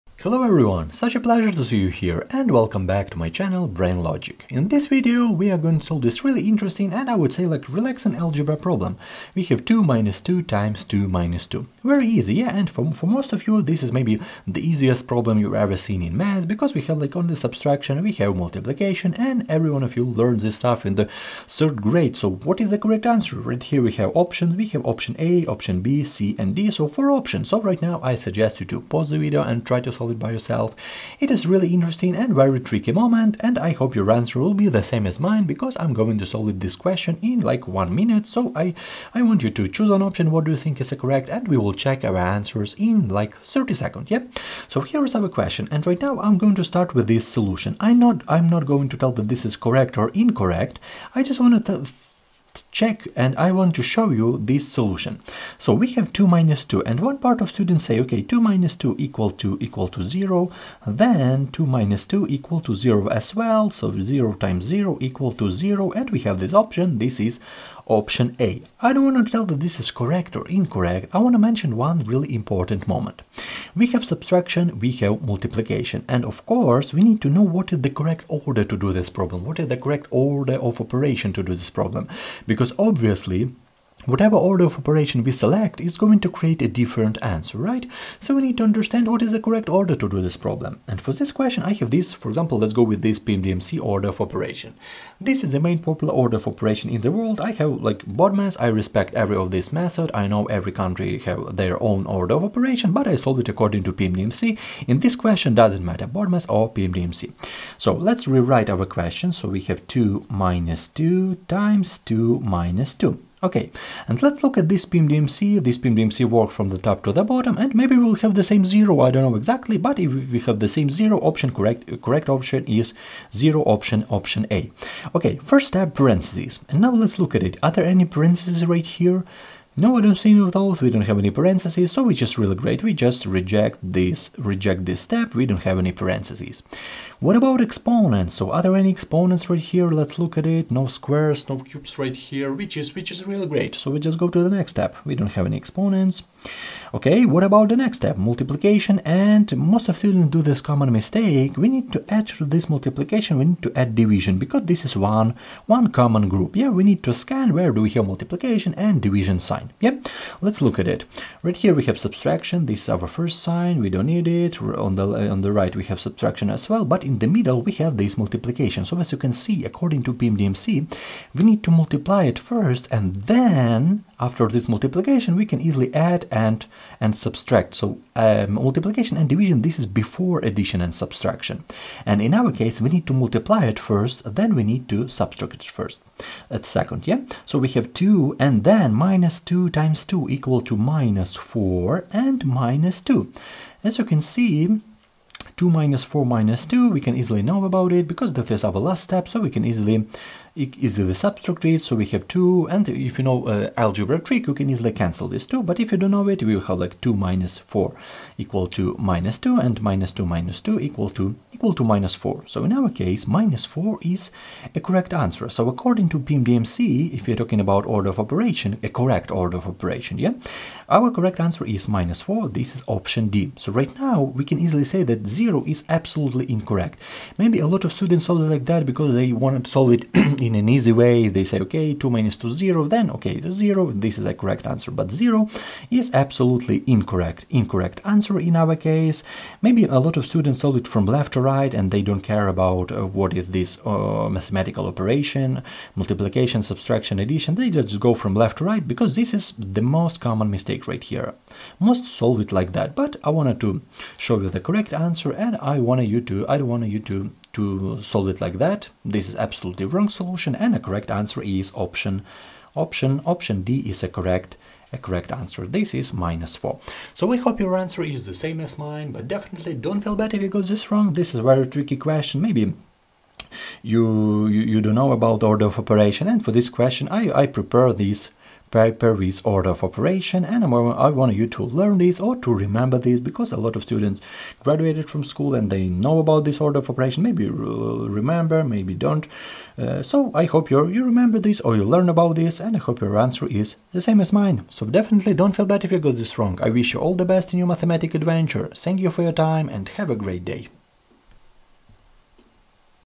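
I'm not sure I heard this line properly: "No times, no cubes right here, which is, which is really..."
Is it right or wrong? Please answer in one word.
wrong.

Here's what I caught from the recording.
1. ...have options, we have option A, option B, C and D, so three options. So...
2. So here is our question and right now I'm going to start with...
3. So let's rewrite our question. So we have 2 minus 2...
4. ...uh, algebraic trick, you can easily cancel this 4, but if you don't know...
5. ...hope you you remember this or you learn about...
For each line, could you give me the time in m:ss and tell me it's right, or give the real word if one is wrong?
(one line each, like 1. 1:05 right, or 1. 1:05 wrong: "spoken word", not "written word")
1. 0:23 wrong: "four", not "three"
2. 0:44 right
3. 1:47 right
4. 3:23 wrong: "2", not "4"
5. 4:50 right.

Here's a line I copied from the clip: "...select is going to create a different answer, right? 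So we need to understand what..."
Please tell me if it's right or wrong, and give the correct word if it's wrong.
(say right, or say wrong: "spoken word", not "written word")
right.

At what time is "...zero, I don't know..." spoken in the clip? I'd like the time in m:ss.
1:58.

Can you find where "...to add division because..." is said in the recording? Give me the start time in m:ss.
2:33.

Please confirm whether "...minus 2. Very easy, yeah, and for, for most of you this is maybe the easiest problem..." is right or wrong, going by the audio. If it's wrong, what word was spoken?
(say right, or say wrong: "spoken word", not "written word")
right.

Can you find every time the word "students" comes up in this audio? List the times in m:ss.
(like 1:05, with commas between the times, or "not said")
0:57, 2:29, 3:47, 4:00, 4:43.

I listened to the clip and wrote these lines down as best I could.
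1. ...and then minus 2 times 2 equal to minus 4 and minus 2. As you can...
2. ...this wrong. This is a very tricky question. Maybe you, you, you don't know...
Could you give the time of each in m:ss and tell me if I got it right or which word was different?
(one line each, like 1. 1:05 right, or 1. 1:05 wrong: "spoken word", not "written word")
1. 3:08 right
2. 4:30 right.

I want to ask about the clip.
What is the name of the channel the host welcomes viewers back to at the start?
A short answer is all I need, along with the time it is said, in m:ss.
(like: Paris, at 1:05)
Brian Logic, at 0:03.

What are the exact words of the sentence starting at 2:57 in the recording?
So um, multiplication and division, this is before addition and subtraction.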